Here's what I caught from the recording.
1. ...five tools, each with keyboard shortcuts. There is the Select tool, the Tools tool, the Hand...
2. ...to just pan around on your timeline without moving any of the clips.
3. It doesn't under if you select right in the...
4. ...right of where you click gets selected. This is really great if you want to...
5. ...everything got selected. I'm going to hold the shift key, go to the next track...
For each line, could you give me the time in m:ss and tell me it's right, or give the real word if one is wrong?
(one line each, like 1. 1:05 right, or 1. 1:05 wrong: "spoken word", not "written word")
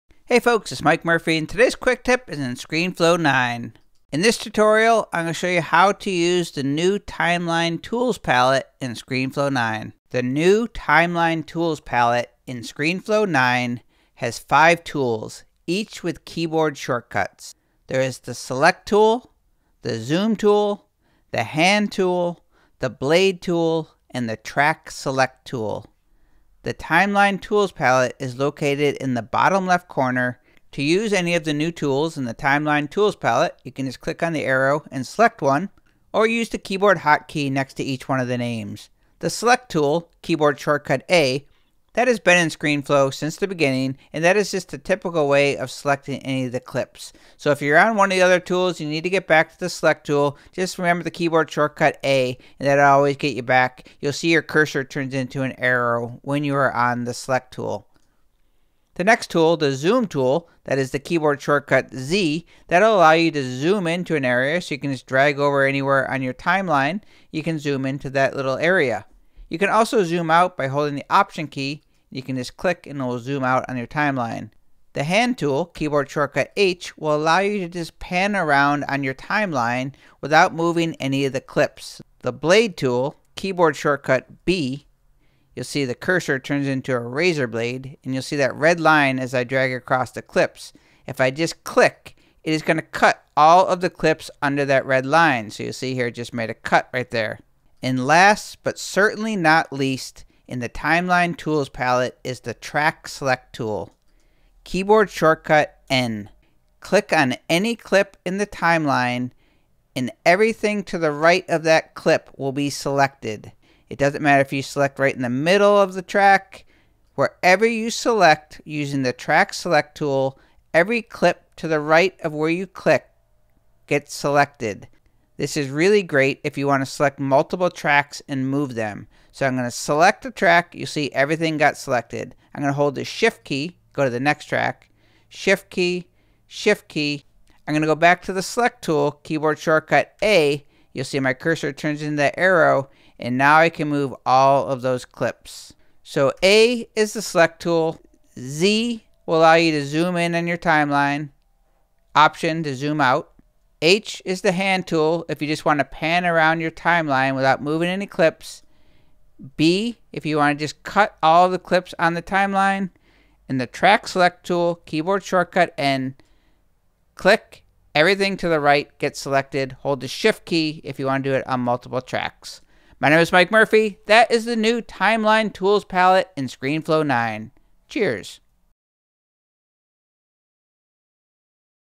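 1. 0:14 wrong: "Zoom", not "Tools"
2. 1:17 right
3. 1:53 wrong: "matter", not "under"
4. 2:01 right
5. 2:11 right.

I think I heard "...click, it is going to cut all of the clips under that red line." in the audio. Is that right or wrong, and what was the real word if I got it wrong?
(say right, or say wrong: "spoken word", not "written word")
right.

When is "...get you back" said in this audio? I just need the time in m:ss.
0:53.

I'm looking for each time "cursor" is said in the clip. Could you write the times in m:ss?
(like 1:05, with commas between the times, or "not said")
0:54, 1:25, 2:21.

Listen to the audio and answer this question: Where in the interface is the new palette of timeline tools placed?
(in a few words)
Bottom left corner.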